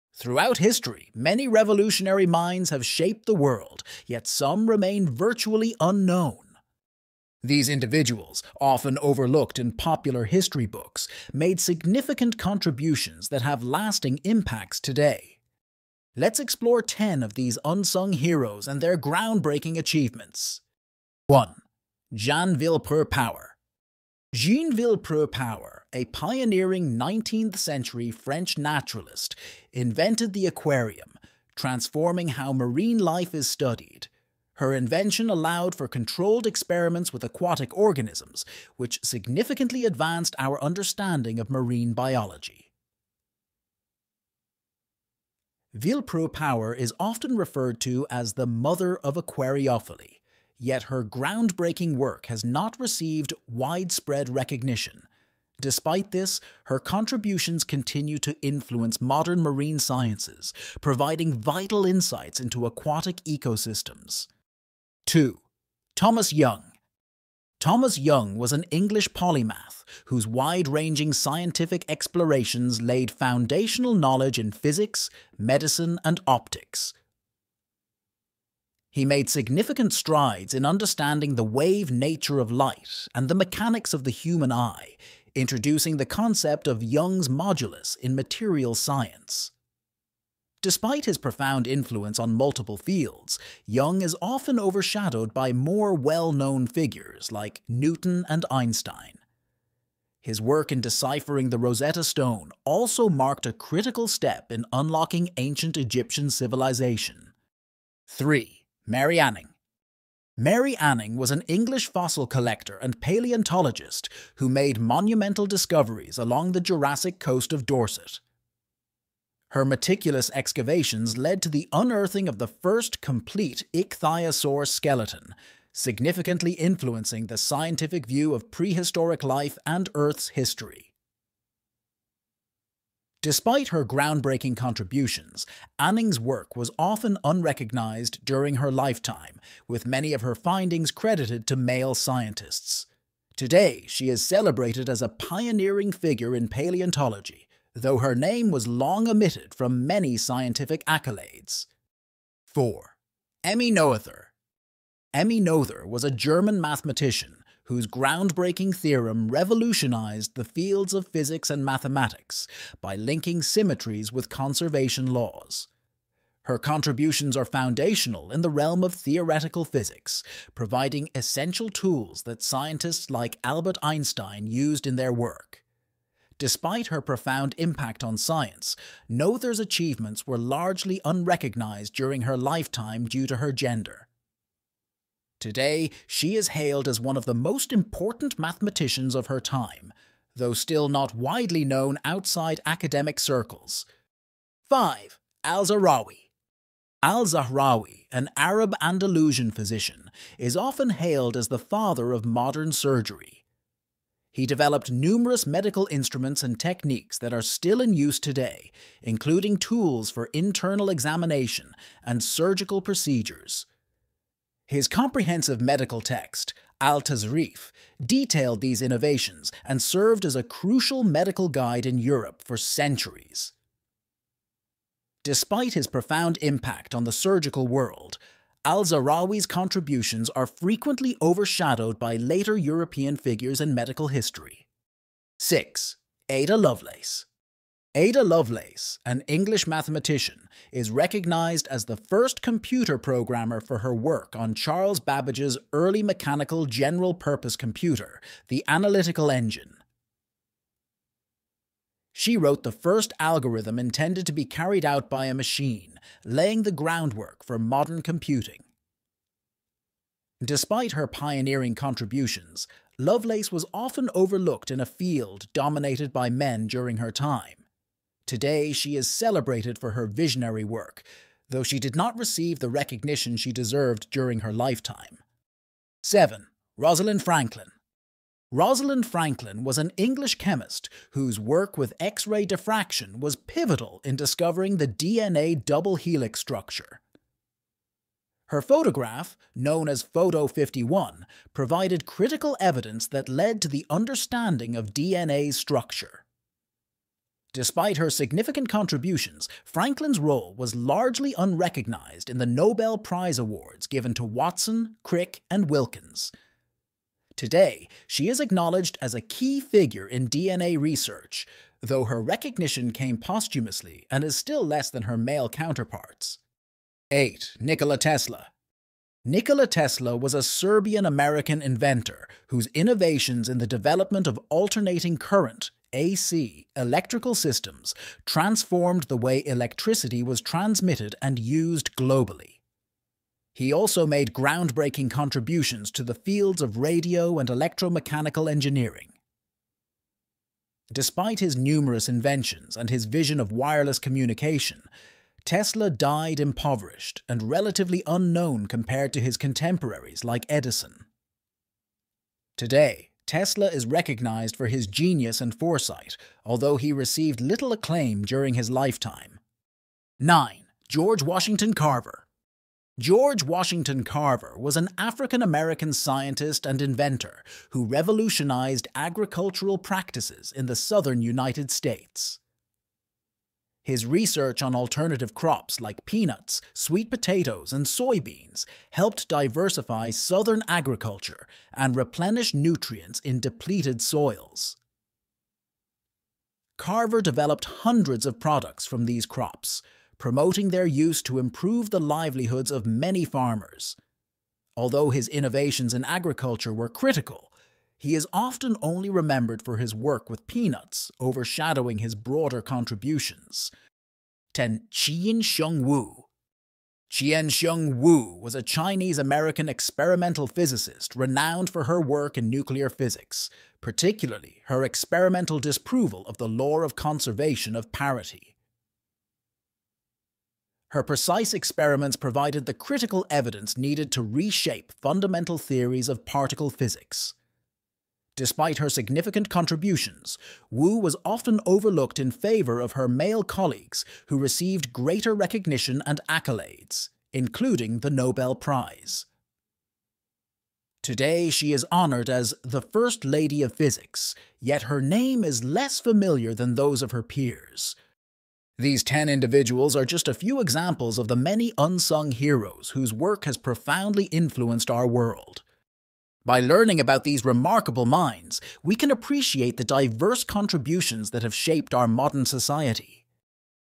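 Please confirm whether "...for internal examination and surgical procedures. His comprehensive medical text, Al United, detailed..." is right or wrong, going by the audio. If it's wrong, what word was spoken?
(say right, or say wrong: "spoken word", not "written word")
wrong: "Tasrif", not "United".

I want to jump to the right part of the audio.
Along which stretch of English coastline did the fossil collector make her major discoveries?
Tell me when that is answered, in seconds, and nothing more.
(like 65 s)
116 s.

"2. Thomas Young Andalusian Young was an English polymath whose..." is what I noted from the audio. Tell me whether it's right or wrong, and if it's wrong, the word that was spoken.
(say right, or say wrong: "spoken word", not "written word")
wrong: "Thomas", not "Andalusian".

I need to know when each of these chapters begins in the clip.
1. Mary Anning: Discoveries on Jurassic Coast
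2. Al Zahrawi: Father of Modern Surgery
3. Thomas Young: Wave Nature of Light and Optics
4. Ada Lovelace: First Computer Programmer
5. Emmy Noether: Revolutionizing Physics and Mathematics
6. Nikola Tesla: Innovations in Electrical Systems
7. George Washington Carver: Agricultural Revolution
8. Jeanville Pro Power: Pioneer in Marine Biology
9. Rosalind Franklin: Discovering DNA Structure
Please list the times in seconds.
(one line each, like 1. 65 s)
1. 118 s
2. 193 s
3. 80 s
4. 231 s
5. 157 s
6. 312 s
7. 349 s
8. 39 s
9. 271 s.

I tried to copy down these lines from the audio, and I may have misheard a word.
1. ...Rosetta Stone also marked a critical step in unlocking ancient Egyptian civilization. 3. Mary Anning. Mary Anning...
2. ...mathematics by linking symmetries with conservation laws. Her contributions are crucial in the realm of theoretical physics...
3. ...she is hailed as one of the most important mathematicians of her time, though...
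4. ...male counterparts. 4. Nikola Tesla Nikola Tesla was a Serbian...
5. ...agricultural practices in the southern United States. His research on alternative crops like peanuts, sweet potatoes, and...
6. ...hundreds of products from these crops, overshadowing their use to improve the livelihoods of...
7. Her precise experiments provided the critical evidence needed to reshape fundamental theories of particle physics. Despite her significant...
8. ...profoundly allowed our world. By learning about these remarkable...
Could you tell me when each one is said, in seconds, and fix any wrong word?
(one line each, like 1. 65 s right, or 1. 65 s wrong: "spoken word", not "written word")
1. 101 s right
2. 161 s wrong: "foundational", not "crucial"
3. 186 s right
4. 315 s wrong: "8", not "4"
5. 368 s right
6. 387 s wrong: "promoting", not "overshadowing"
7. 420 s right
8. 453 s wrong: "influenced", not "allowed".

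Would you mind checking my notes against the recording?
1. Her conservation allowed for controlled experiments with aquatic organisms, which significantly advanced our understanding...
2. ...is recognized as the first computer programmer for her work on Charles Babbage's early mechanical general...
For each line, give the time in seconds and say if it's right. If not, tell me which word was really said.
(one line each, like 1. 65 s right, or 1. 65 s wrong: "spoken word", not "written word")
1. 34 s wrong: "invention", not "conservation"
2. 240 s right.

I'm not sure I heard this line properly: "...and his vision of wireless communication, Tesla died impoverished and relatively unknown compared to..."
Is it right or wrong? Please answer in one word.
right.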